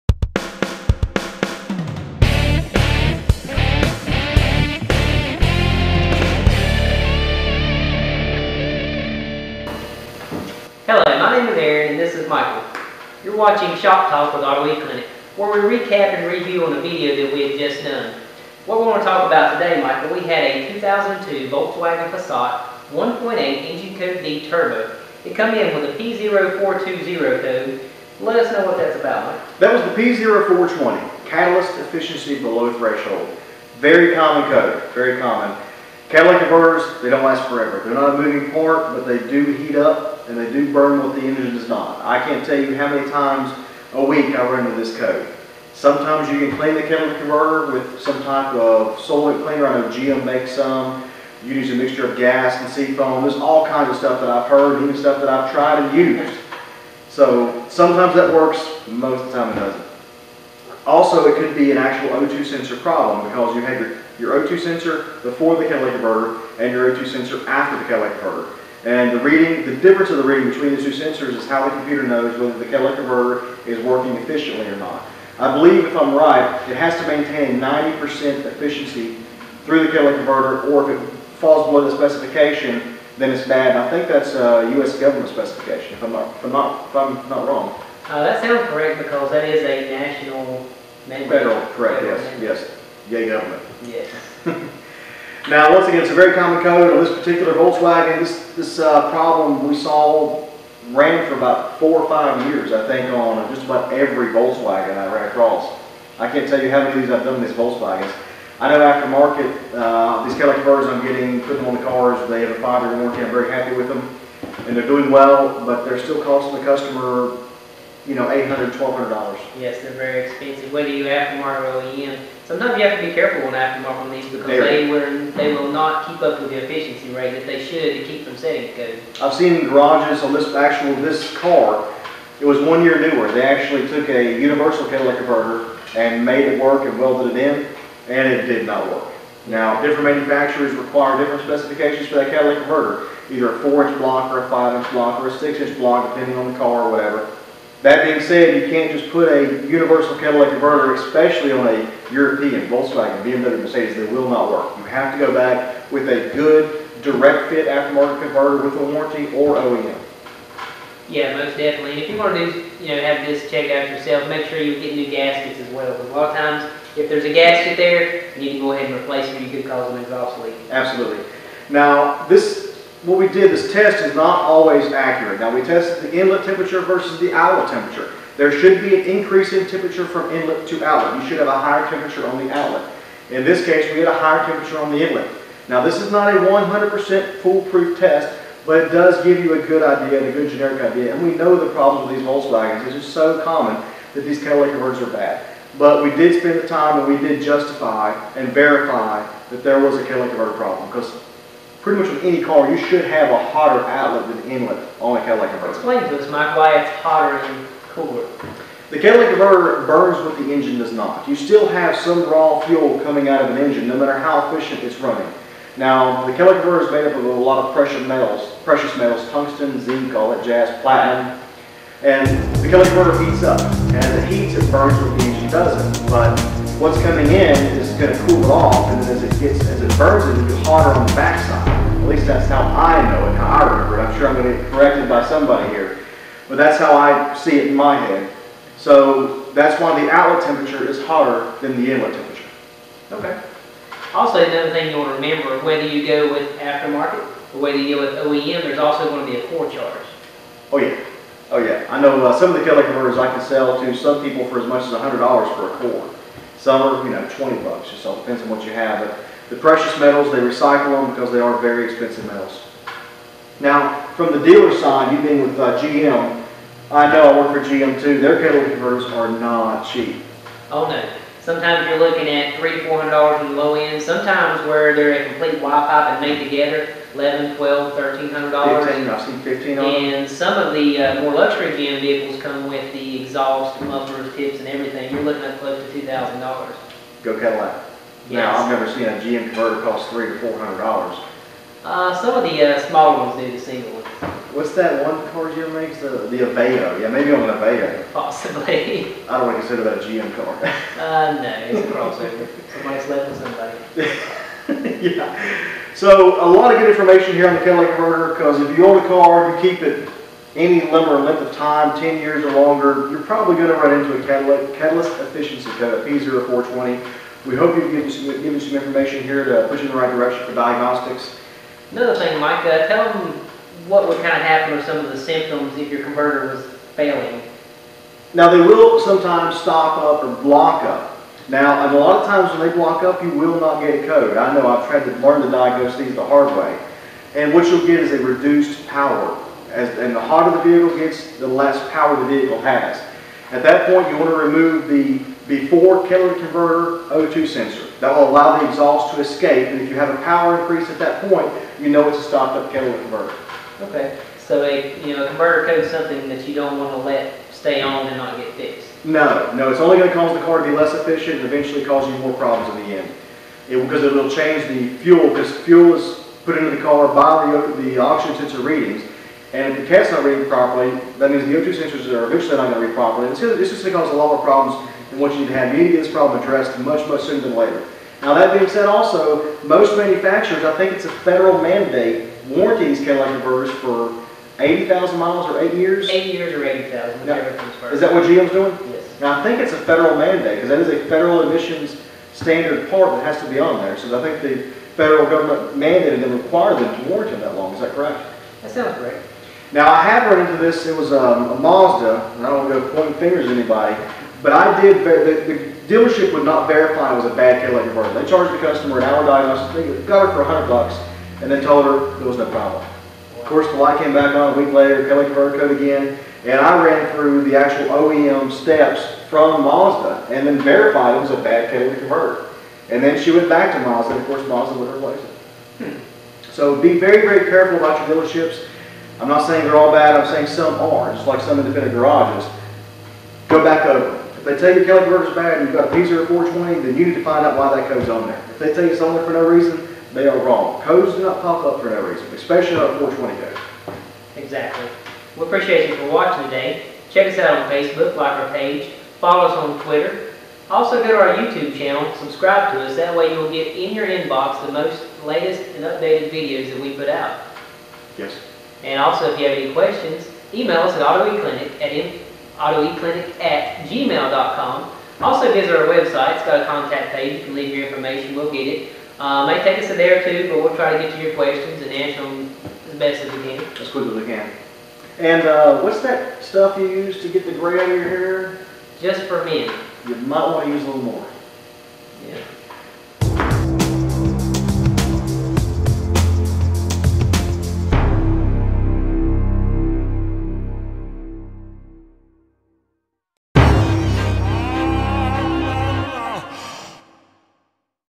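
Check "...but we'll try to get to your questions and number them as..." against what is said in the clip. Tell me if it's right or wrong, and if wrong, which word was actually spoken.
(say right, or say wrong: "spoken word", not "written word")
wrong: "answer", not "number".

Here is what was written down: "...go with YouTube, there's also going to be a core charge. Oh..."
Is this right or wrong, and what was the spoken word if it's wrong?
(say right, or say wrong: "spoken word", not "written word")
wrong: "OEM", not "YouTube".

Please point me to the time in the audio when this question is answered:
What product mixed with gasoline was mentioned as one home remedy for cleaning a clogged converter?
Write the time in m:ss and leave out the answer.
0:52.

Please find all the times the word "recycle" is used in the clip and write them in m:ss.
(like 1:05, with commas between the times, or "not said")
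4:20.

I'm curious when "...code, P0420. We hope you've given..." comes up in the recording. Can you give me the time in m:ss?
5:15.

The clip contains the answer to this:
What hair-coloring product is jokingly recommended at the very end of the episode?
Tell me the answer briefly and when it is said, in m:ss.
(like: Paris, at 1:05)
Just for Men, at 7:59.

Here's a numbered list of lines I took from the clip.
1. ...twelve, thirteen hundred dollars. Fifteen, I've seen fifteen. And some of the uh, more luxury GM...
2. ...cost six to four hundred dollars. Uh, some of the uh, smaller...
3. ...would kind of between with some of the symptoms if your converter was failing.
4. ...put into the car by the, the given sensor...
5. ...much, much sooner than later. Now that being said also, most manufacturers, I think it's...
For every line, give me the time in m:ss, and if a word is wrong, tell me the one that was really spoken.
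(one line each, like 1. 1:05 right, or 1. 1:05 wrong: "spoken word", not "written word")
1. 4:37 right
2. 4:49 wrong: "three", not "six"
3. 5:24 wrong: "happen", not "between"
4. 6:06 wrong: "oxygen", not "given"
5. 6:16 right.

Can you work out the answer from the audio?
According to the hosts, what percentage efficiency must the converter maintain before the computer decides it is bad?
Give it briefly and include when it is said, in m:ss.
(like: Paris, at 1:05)
90%, at 1:17.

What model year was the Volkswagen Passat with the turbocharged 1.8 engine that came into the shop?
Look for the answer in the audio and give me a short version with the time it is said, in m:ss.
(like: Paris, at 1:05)
2002, at 0:20.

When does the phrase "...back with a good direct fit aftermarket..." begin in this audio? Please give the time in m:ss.
2:35.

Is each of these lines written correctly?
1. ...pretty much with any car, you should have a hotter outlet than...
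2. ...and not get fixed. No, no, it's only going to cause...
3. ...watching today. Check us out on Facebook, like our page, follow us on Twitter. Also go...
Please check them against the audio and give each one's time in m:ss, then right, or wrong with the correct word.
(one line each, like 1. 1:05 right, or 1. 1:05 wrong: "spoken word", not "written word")
1. 3:21 right
2. 5:58 right
3. 7:26 right.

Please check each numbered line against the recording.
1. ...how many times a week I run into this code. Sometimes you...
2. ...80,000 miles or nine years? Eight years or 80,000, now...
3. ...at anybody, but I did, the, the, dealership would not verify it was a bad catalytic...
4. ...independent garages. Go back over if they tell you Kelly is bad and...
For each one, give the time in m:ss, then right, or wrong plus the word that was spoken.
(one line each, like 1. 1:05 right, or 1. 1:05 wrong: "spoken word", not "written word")
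1. 0:42 right
2. 6:24 wrong: "eight", not "nine"
3. 6:43 right
4. 7:11 right.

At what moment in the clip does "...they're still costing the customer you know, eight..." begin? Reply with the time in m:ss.
1:55.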